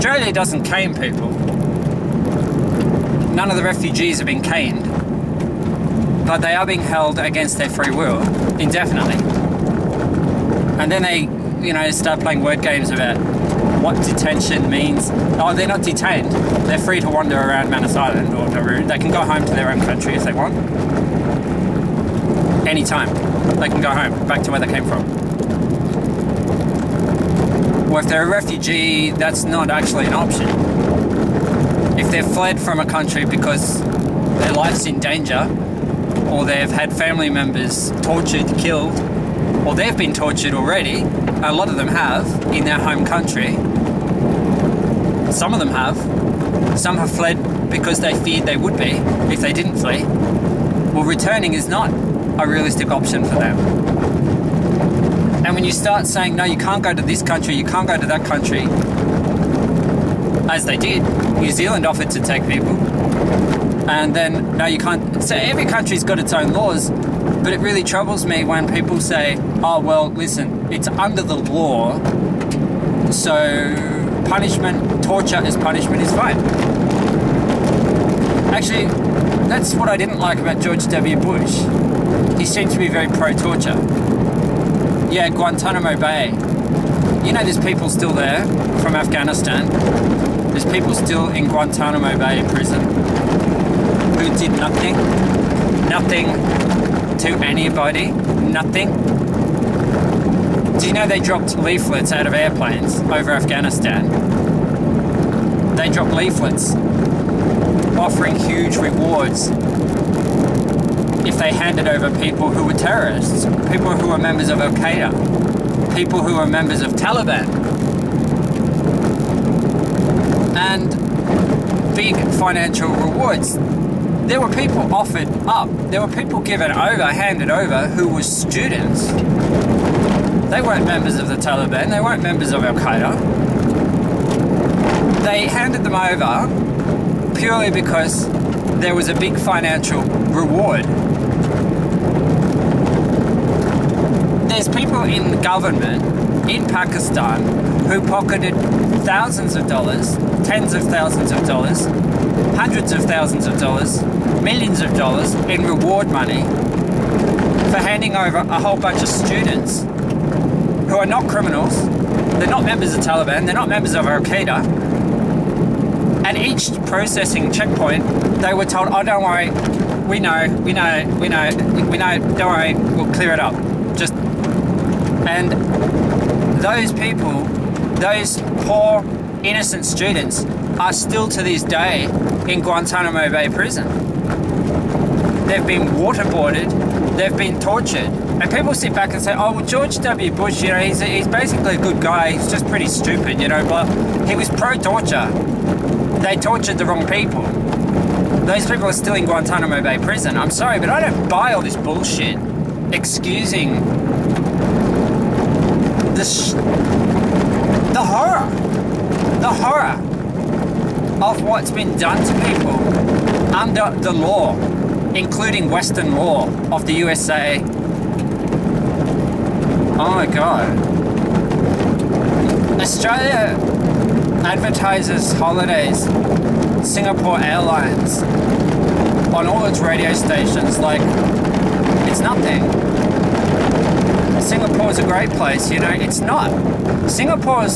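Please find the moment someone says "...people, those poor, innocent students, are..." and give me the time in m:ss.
2:56.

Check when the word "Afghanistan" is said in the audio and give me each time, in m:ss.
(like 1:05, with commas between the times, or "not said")
1:28, 1:43.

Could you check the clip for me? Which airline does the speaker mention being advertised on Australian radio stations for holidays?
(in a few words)
Singapore Airlines.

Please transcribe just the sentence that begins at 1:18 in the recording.
Actually, that's what I didn't like about George W.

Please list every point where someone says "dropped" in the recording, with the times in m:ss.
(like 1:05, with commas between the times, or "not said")
1:41, 1:45.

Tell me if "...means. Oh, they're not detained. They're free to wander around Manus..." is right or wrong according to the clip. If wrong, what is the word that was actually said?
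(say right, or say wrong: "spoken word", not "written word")
right.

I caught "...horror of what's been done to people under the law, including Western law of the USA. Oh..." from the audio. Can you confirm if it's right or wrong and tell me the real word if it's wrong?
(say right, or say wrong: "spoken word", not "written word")
right.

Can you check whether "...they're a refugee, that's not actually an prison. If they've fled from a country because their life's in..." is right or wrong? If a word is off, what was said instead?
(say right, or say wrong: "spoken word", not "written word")
wrong: "option", not "prison".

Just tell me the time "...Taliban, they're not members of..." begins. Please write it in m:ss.
2:43.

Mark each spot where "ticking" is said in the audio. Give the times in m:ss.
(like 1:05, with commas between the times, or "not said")
not said.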